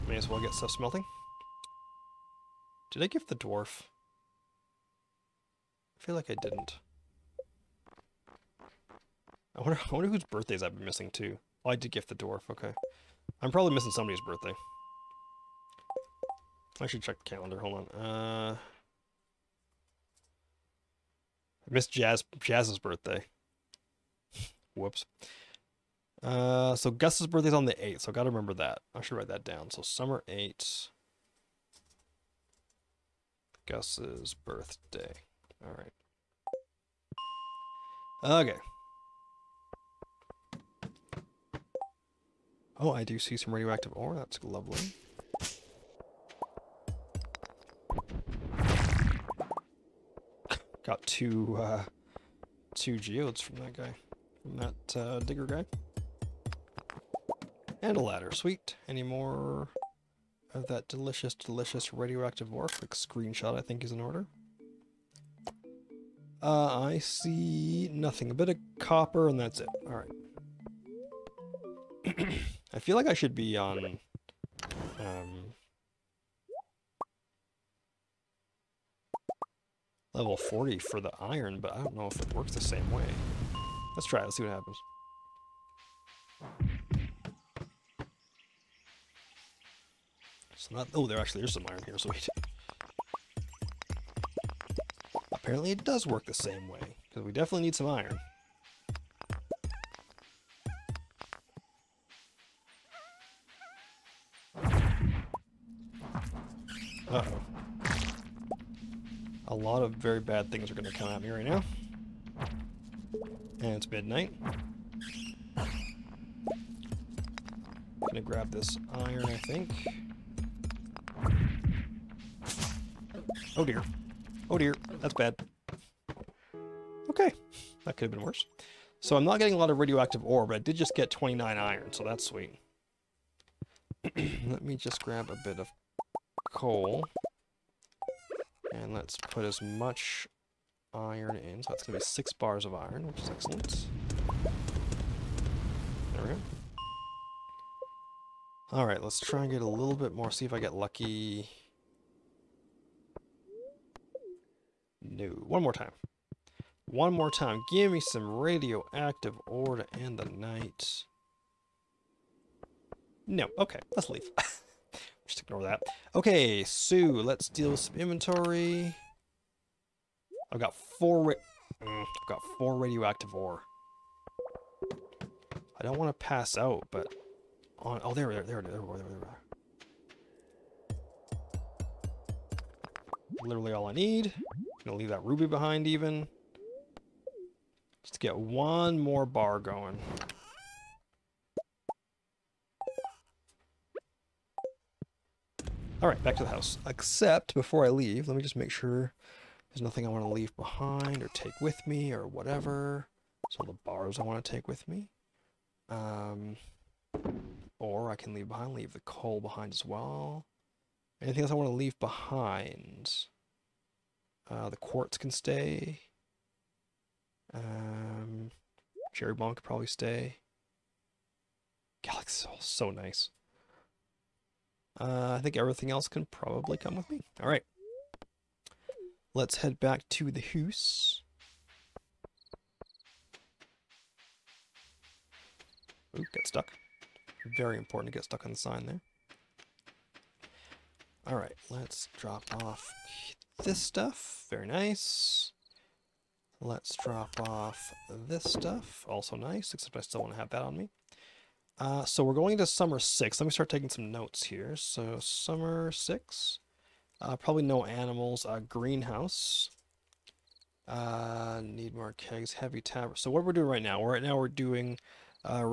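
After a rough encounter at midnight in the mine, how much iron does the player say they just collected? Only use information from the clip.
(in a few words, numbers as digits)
29.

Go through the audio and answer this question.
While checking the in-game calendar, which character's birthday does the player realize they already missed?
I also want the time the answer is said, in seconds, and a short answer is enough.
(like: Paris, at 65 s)
Jas, at 22 s.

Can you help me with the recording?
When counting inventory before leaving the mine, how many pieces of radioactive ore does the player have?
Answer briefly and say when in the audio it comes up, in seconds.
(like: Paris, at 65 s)
4, at 172 s.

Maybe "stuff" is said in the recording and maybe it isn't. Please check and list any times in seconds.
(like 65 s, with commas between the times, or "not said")
0 s, 243 s, 248 s.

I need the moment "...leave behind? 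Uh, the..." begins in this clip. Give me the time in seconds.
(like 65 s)
211 s.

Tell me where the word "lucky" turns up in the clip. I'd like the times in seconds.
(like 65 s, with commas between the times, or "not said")
150 s.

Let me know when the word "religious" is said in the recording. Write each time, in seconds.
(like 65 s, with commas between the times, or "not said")
not said.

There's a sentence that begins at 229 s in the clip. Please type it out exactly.
Let's head back to the hoose.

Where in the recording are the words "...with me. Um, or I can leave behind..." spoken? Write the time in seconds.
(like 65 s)
204 s.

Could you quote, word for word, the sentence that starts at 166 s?
Okay, so let's deal with some inventory.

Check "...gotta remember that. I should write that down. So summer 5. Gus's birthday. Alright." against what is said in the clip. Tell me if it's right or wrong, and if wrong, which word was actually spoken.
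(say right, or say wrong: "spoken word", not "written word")
wrong: "8", not "5".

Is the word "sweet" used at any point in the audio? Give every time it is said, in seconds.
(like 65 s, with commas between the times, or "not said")
58 s, 132 s.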